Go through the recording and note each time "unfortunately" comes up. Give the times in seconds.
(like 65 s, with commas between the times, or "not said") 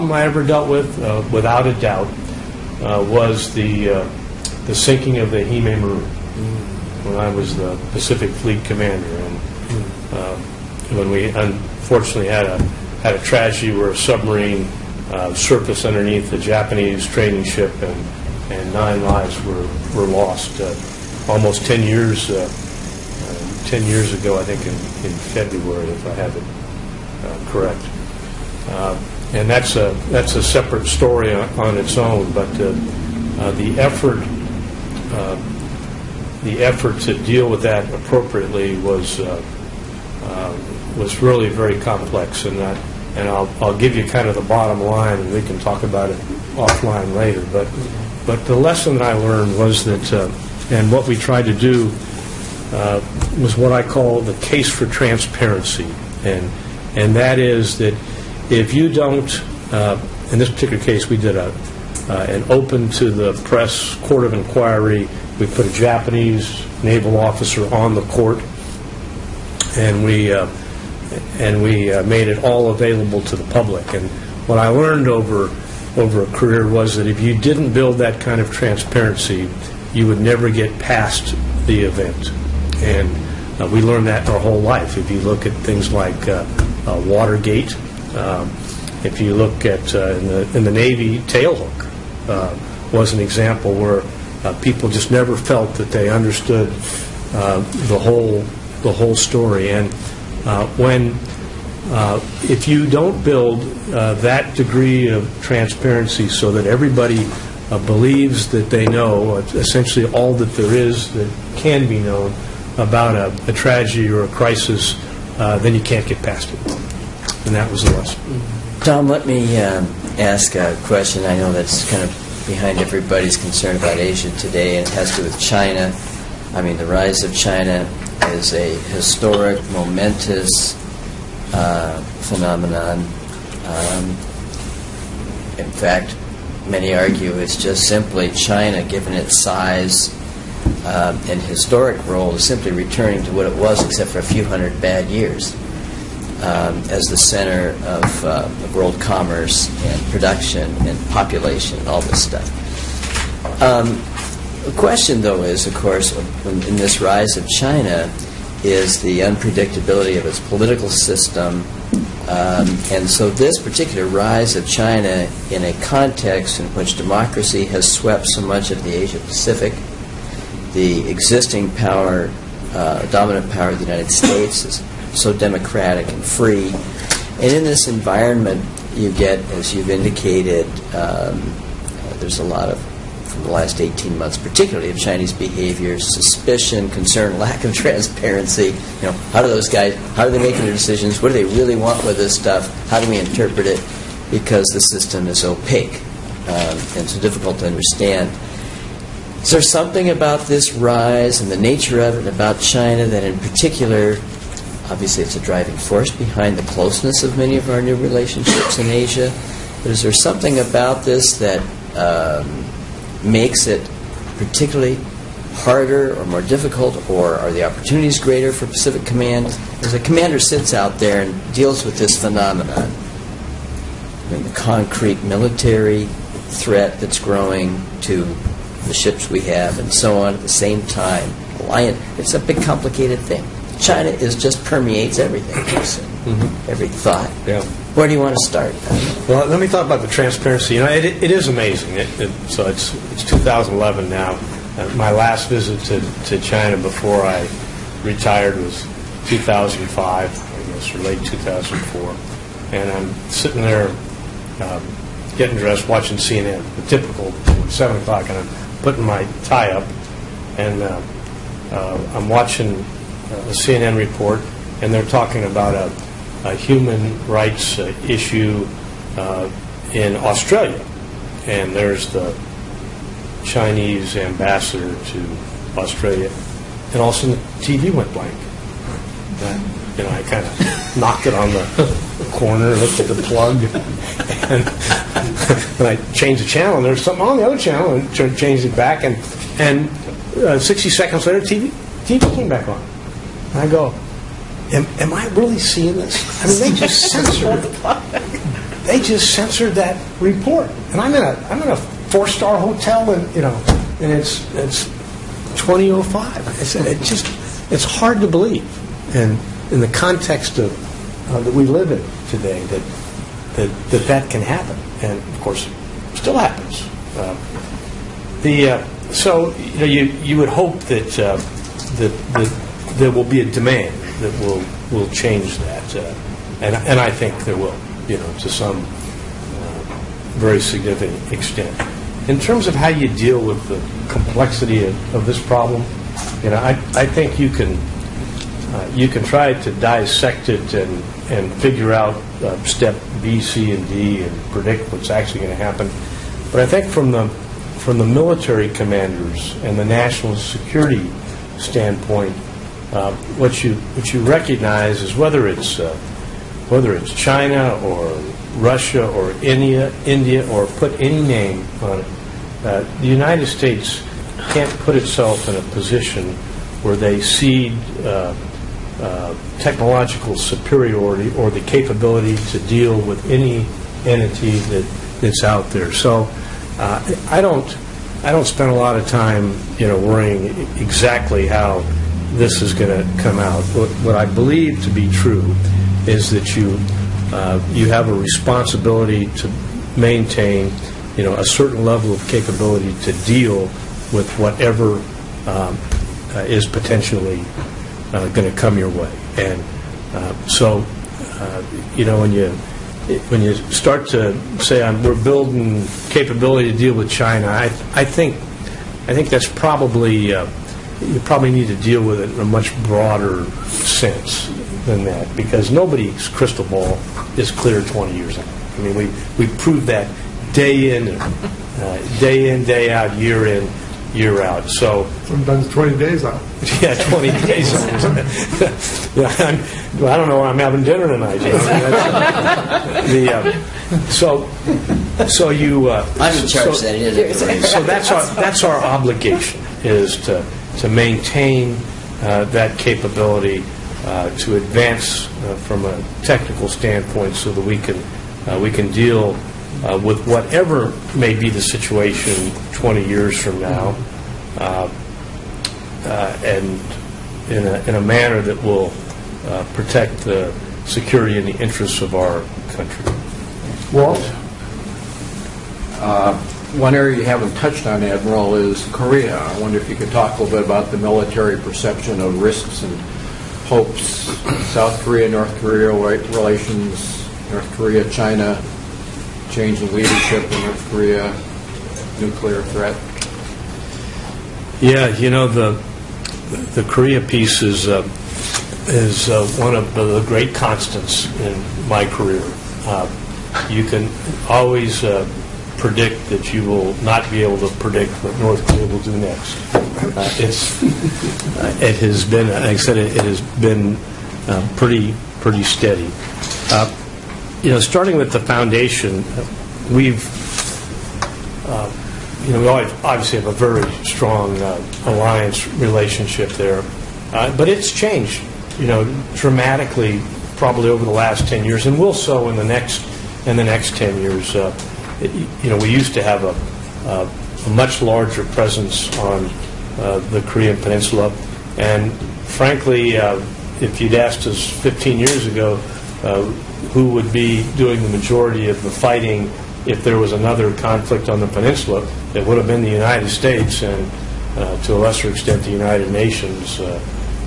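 11 s.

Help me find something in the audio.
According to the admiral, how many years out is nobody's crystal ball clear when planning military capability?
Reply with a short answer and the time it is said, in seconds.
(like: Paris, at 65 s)
20, at 417 s.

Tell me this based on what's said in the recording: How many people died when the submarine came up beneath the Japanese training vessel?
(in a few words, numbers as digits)
9.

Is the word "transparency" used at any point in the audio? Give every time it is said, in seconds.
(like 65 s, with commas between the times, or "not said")
54 s, 78 s, 105 s, 187 s, 240 s.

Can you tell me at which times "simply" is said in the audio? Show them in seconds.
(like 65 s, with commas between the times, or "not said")
137 s, 142 s.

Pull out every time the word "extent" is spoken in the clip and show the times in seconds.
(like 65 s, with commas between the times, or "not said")
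331 s, 545 s.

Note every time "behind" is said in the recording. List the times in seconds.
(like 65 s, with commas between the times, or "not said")
122 s, 206 s.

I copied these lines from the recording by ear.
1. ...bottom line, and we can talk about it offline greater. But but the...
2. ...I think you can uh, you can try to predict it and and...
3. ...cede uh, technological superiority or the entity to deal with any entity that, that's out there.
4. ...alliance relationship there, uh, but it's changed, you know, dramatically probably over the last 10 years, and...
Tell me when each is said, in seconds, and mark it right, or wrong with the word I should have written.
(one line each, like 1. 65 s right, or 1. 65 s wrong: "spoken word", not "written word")
1. 44 s wrong: "later", not "greater"
2. 336 s wrong: "dissect", not "predict"
3. 367 s wrong: "capability", not "entity"
4. 515 s right.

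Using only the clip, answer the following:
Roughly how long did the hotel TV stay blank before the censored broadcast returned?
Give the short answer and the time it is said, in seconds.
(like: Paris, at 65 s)
60 seconds, at 290 s.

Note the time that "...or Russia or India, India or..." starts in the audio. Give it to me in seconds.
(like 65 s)
357 s.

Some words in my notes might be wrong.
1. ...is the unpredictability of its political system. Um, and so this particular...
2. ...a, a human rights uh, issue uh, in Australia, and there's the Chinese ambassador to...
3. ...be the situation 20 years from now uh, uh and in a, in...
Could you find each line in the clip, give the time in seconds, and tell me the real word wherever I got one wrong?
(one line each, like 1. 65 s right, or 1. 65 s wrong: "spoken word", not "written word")
1. 158 s right
2. 265 s right
3. 451 s right.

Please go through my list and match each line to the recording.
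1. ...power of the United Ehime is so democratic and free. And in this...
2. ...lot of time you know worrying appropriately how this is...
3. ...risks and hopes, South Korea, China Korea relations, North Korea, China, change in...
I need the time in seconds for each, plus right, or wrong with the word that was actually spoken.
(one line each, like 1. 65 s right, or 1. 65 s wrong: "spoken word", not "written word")
1. 173 s wrong: "States", not "Ehime"
2. 378 s wrong: "exactly", not "appropriately"
3. 472 s wrong: "North", not "China".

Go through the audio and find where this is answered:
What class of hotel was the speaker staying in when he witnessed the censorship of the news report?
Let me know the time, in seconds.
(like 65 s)
301 s.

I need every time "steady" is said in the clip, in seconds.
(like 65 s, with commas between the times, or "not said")
505 s.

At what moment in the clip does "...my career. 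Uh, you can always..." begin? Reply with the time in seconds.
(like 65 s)
491 s.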